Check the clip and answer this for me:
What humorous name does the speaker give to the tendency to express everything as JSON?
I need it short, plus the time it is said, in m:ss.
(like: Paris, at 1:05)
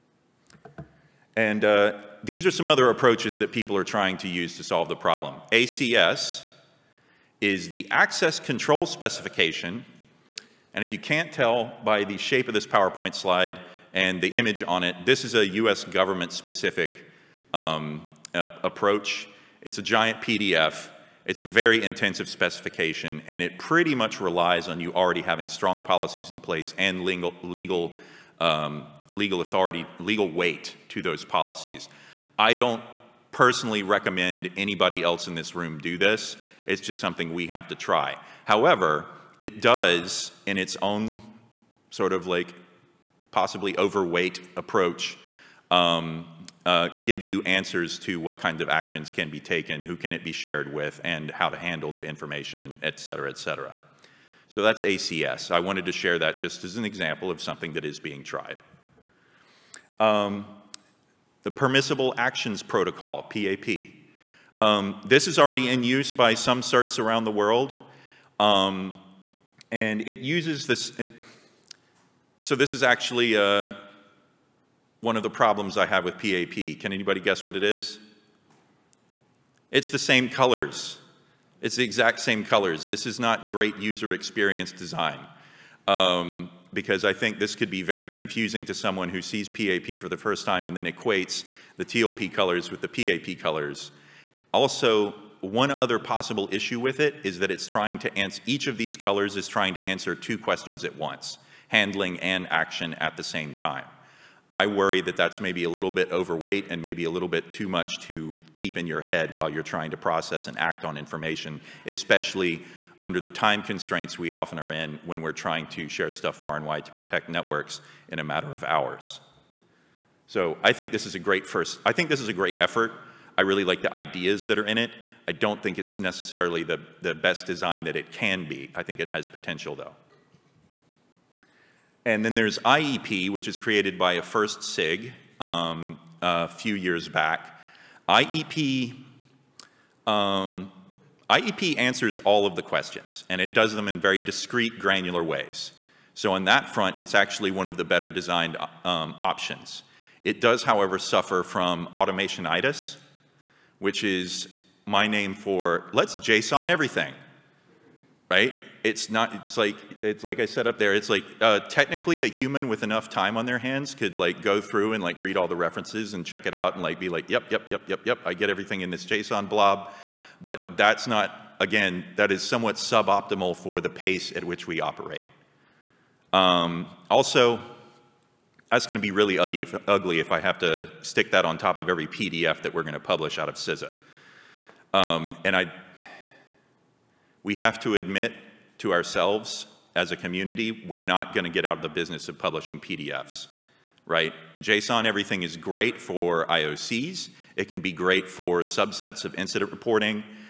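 automationitis, at 2:31.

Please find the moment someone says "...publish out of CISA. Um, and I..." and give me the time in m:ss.
3:03.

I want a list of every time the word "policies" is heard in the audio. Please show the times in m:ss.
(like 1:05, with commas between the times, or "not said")
0:25, 0:31.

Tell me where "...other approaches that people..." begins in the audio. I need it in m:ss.
0:02.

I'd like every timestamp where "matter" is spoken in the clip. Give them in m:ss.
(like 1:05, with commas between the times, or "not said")
1:58.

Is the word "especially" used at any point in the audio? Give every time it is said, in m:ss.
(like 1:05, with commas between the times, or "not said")
1:51.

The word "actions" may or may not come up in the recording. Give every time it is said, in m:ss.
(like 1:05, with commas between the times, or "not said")
0:48, 1:02, 1:42.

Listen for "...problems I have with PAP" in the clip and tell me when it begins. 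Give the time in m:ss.
1:15.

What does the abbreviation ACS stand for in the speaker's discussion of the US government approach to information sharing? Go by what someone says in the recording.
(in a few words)
access control specification.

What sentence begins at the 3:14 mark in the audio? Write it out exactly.
JSON, everything is great for IOCs.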